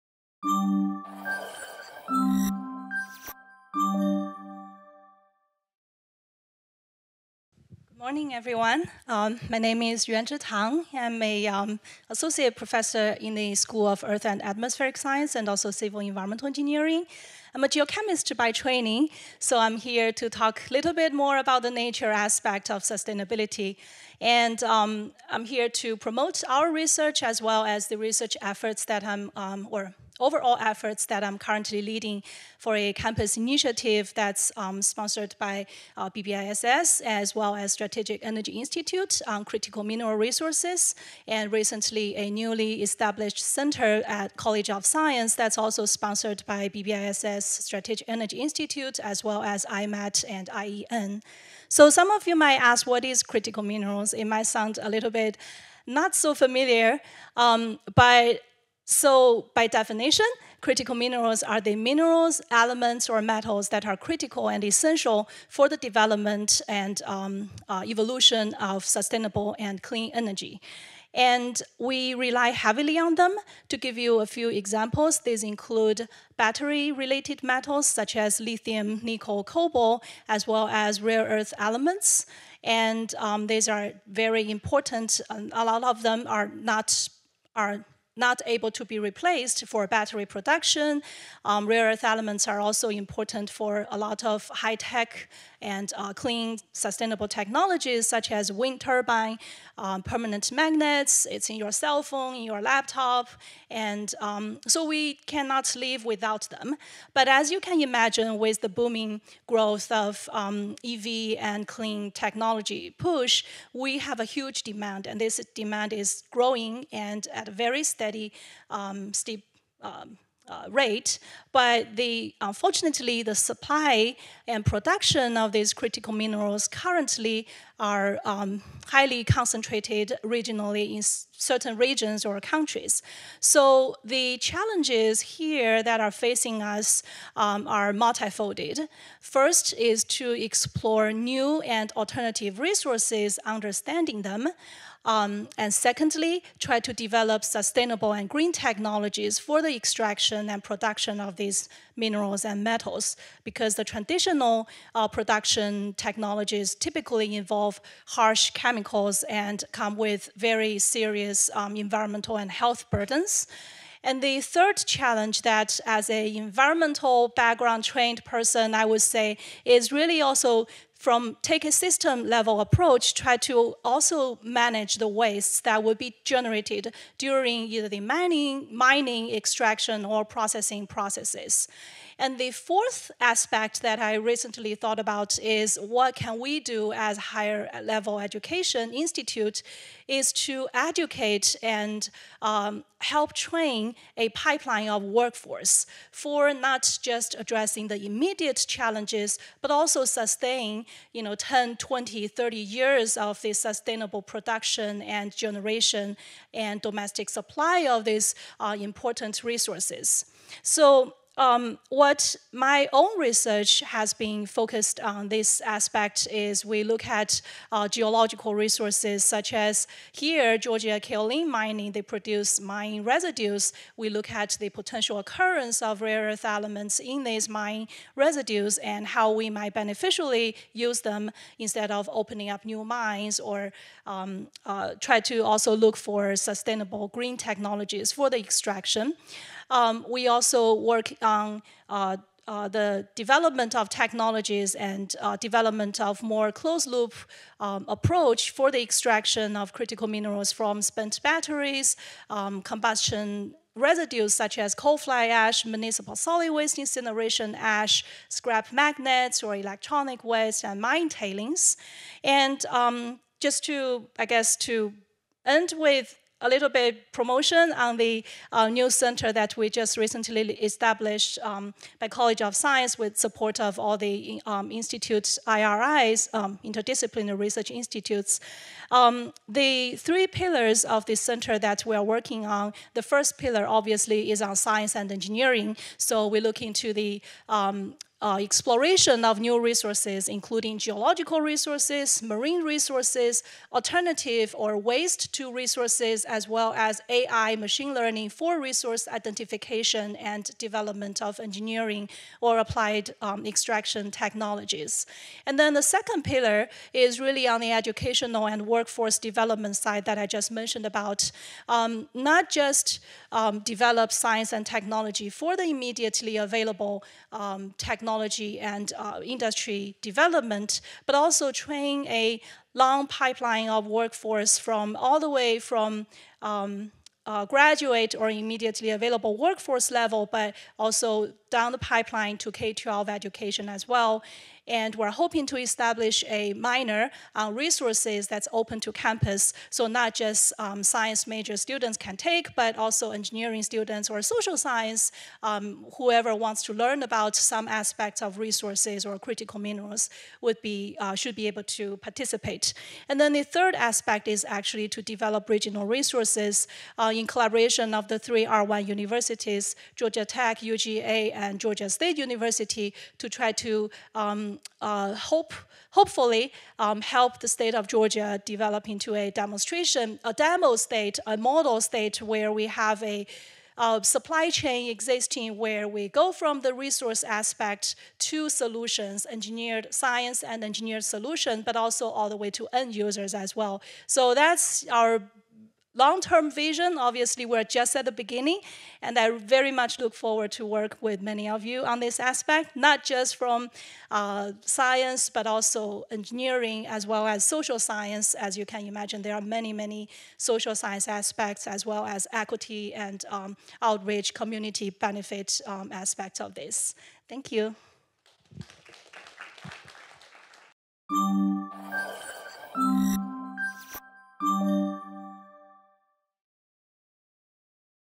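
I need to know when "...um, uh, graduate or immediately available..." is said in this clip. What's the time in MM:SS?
05:26.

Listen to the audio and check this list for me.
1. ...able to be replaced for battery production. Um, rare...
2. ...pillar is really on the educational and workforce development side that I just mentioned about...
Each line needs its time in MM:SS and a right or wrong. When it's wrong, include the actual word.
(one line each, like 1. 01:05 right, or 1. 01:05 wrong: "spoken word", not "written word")
1. 01:28 right
2. 05:06 right.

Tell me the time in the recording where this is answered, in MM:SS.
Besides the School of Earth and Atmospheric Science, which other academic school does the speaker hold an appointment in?
00:15.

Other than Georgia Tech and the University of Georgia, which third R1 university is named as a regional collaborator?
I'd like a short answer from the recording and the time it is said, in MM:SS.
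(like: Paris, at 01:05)
Georgia State University, at 06:01.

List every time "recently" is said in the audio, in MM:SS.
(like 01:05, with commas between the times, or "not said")
00:41, 03:04, 04:29.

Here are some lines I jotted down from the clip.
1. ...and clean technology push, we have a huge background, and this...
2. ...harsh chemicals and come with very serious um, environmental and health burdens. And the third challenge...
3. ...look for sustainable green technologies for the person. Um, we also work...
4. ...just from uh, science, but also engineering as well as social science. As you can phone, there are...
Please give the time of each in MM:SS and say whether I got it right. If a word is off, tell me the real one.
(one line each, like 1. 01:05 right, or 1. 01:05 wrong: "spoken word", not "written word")
1. 01:51 wrong: "demand", not "background"
2. 02:38 right
3. 03:55 wrong: "extraction", not "person"
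4. 06:33 wrong: "imagine", not "phone".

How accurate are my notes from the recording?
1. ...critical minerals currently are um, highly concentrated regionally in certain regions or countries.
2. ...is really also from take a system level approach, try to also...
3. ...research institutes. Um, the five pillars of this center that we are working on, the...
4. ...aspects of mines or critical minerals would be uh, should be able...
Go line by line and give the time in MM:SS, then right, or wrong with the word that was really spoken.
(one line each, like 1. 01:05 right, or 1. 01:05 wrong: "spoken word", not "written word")
1. 02:05 right
2. 02:49 right
3. 04:37 wrong: "three", not "five"
4. 05:47 wrong: "resources", not "mines".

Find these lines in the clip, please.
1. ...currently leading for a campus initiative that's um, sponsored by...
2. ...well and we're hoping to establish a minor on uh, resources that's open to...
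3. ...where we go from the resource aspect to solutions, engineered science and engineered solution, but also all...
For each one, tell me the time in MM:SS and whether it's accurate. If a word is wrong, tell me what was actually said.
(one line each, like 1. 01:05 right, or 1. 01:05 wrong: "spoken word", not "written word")
1. 00:31 right
2. 05:33 right
3. 06:15 right.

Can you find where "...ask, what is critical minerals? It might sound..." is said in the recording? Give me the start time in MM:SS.
00:52.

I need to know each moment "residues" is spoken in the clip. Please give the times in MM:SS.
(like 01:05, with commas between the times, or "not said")
03:43, 03:48, 04:13.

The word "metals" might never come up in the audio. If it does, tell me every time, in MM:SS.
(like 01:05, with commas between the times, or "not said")
01:03, 01:17, 02:32.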